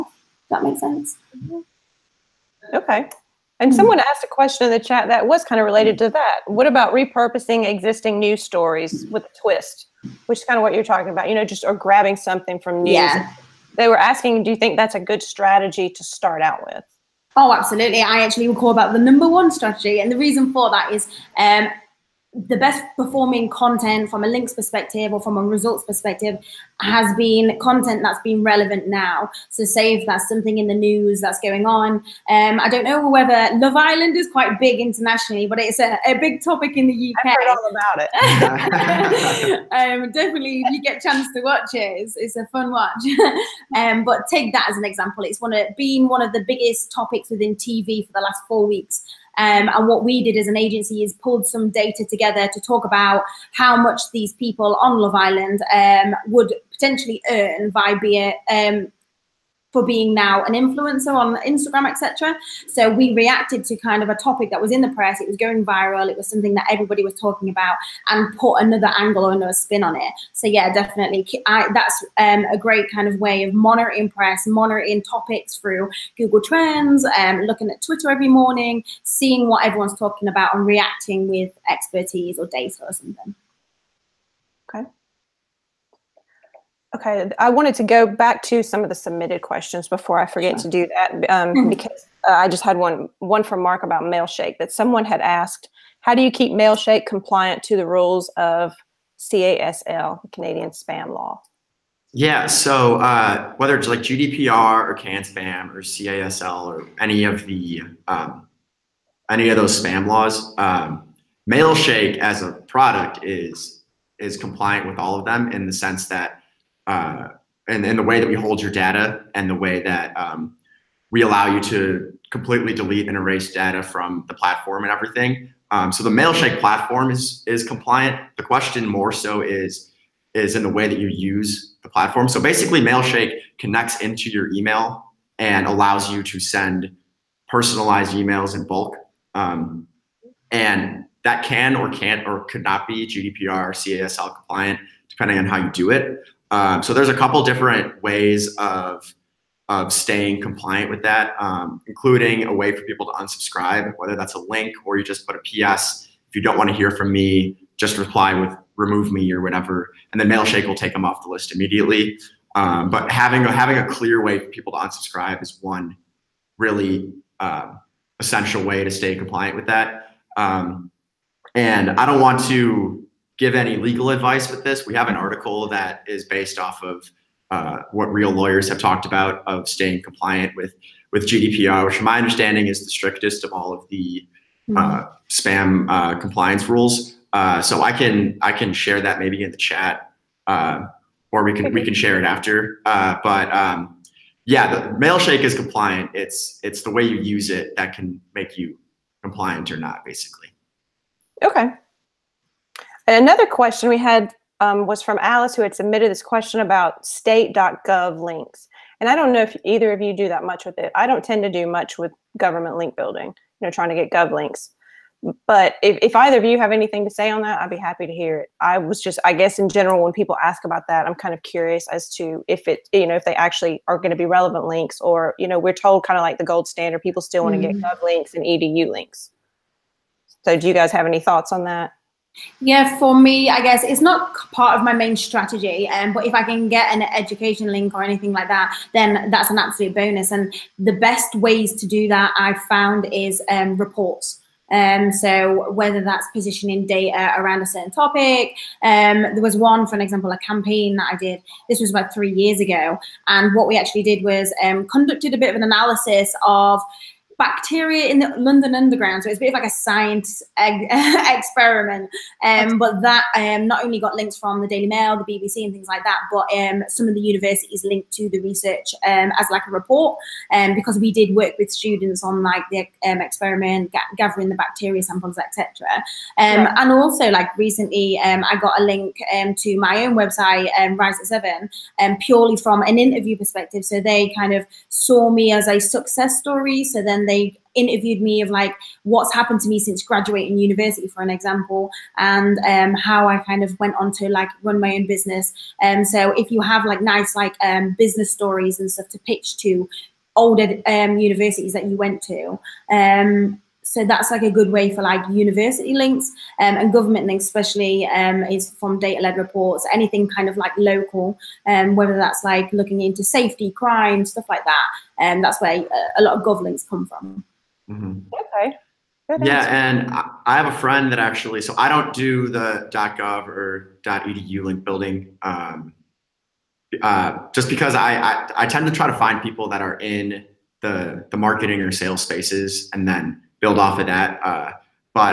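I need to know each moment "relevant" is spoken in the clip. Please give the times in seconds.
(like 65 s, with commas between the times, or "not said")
28 s, 224 s.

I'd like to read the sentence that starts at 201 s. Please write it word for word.
Okay, and another question we had um, was from Alice, who had submitted this question about state.gov links.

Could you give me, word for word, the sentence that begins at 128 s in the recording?
The question more so is is in the way that you use the platform.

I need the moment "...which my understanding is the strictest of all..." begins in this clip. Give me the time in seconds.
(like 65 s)
181 s.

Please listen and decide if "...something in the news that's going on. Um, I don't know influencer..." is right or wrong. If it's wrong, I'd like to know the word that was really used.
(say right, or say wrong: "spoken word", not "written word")
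wrong: "whether", not "influencer".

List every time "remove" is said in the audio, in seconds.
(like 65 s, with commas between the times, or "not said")
158 s.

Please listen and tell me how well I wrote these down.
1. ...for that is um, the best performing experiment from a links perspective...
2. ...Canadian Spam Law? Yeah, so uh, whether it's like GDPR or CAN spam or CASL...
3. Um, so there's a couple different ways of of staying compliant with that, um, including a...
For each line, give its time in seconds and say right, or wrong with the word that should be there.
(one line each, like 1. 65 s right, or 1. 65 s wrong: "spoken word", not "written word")
1. 20 s wrong: "content", not "experiment"
2. 100 s right
3. 146 s right.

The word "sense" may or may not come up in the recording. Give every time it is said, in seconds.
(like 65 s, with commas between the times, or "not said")
0 s, 115 s.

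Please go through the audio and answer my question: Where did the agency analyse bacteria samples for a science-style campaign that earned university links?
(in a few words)
London Underground.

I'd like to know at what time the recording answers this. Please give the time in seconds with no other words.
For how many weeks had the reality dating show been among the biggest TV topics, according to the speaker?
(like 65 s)
48 s.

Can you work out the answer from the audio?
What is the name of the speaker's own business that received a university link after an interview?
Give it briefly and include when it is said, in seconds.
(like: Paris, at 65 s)
Rise at Seven, at 280 s.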